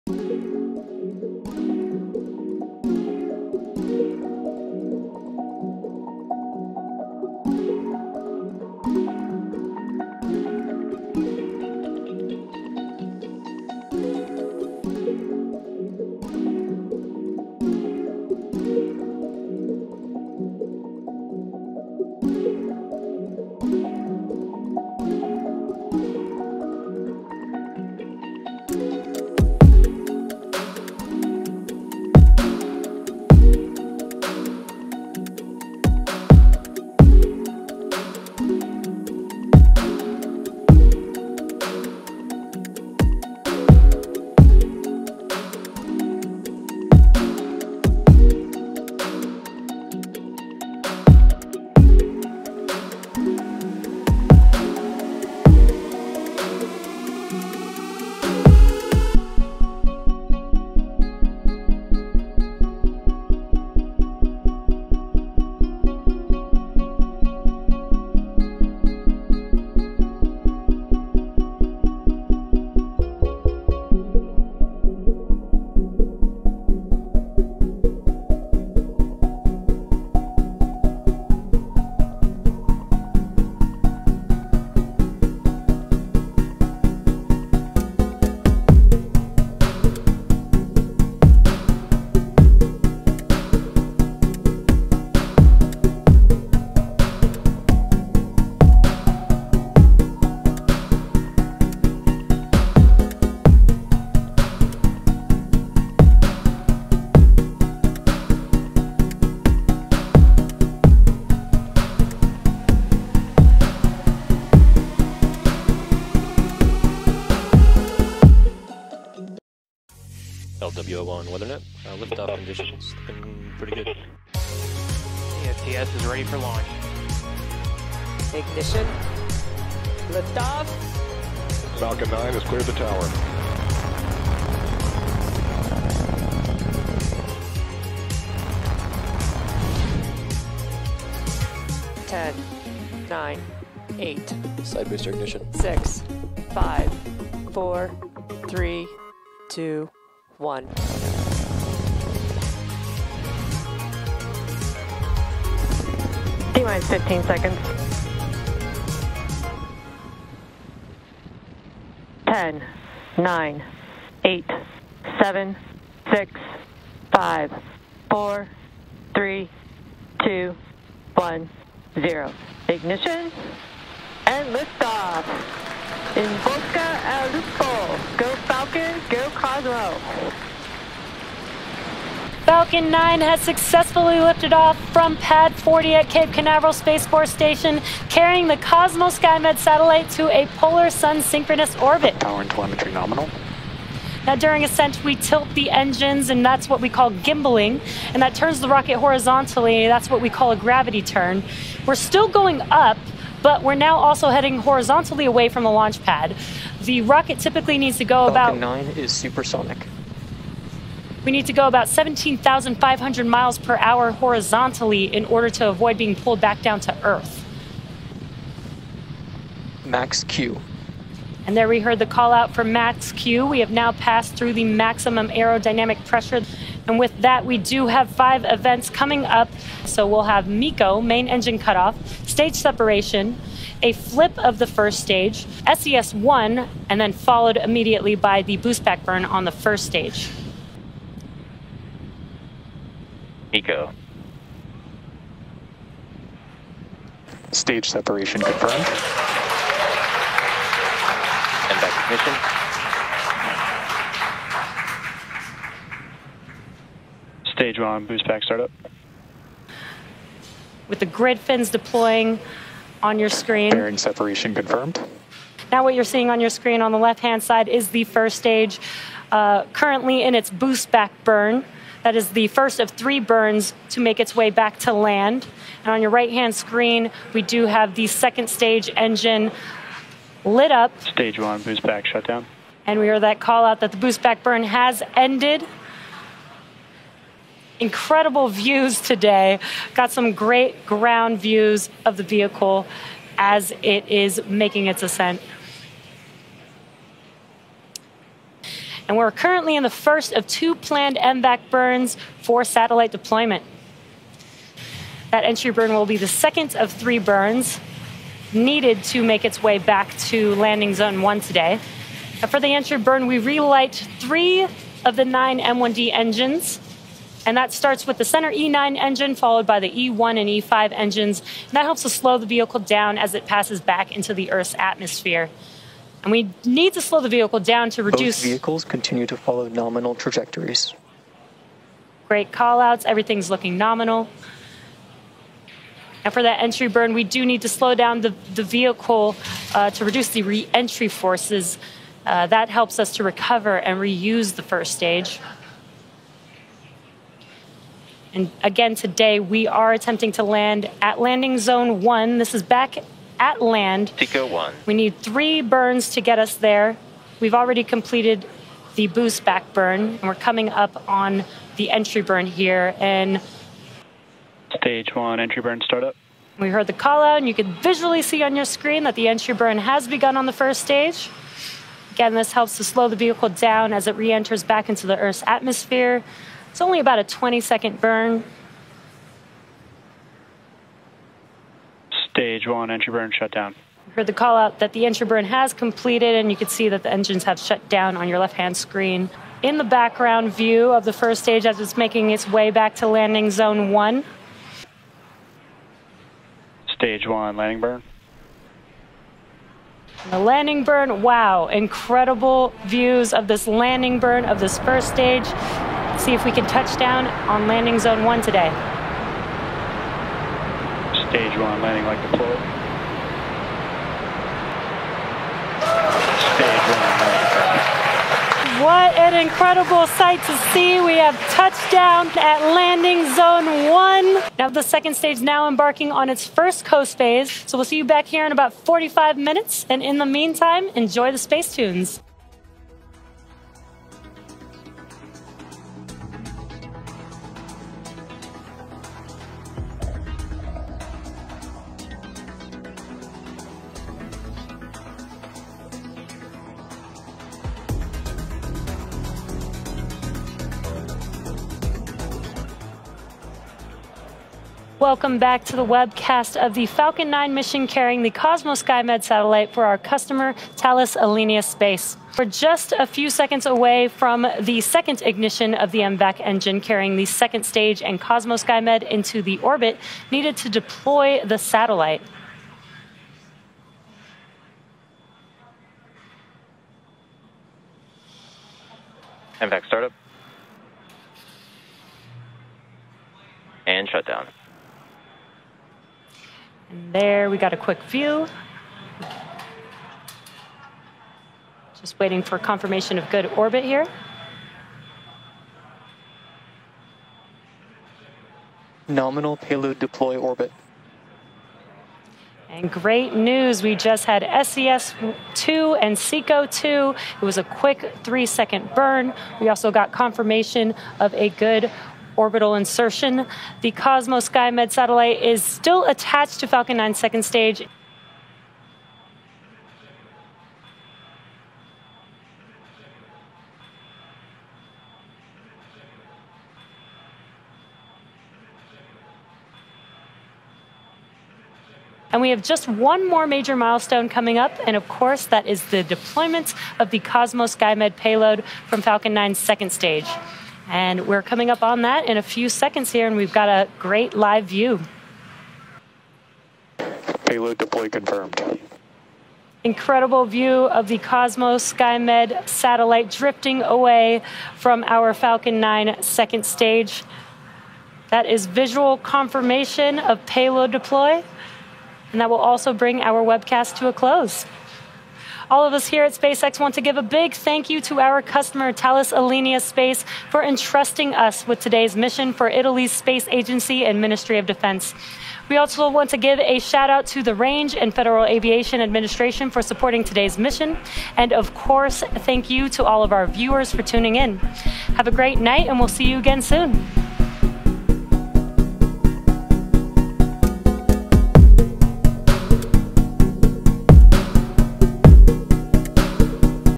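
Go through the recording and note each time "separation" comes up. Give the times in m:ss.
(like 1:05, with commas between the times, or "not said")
3:52, 4:07, 4:23.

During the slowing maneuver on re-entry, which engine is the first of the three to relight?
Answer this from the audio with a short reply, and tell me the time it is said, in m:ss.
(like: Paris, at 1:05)
E9, at 5:18.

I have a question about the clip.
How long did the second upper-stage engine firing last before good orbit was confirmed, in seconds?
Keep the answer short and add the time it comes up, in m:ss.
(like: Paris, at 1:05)
3, at 8:28.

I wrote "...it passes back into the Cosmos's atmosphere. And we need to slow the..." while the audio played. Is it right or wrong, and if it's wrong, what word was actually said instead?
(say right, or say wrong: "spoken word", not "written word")
wrong: "Earth", not "Cosmos".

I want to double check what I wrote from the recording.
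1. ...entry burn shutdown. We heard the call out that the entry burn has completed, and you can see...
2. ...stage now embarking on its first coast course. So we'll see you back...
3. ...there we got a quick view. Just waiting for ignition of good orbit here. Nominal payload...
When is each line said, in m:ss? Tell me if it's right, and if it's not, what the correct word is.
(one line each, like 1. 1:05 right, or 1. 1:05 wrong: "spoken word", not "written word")
1. 6:22 right
2. 7:05 wrong: "phase", not "course"
3. 8:07 wrong: "confirmation", not "ignition".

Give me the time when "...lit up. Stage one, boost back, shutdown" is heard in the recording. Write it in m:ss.
4:40.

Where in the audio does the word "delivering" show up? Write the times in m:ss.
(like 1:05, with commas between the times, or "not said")
not said.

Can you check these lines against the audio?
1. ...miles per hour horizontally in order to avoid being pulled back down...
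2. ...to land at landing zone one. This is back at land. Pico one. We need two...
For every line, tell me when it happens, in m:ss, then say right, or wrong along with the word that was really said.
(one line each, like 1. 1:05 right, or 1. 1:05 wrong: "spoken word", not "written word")
1. 3:33 right
2. 5:50 wrong: "three", not "two".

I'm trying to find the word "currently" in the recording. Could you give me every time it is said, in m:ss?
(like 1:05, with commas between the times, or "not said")
4:29, 4:59.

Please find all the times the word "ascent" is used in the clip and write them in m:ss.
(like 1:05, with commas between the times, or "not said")
3:14, 4:55.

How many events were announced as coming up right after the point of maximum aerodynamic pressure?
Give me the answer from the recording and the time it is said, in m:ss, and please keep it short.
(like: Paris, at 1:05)
5, at 3:48.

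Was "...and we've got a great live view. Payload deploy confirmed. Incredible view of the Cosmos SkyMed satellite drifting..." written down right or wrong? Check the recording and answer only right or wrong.
right.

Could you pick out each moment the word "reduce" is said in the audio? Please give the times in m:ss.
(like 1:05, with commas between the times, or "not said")
5:28, 5:40.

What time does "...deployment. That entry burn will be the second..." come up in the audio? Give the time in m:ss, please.
5:03.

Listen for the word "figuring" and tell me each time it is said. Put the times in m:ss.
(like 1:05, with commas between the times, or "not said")
not said.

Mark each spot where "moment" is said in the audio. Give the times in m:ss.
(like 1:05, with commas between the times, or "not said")
not said.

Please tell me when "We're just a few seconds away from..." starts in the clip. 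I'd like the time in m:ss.
7:42.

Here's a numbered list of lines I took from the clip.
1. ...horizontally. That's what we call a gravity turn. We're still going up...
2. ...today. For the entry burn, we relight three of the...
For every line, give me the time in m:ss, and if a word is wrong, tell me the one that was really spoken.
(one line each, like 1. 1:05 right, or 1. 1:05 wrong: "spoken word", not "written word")
1. 3:18 right
2. 5:11 right.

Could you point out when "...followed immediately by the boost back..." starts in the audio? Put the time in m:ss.
3:57.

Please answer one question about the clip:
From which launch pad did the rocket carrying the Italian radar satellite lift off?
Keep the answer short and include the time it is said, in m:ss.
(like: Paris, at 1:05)
Pad 40, at 3:05.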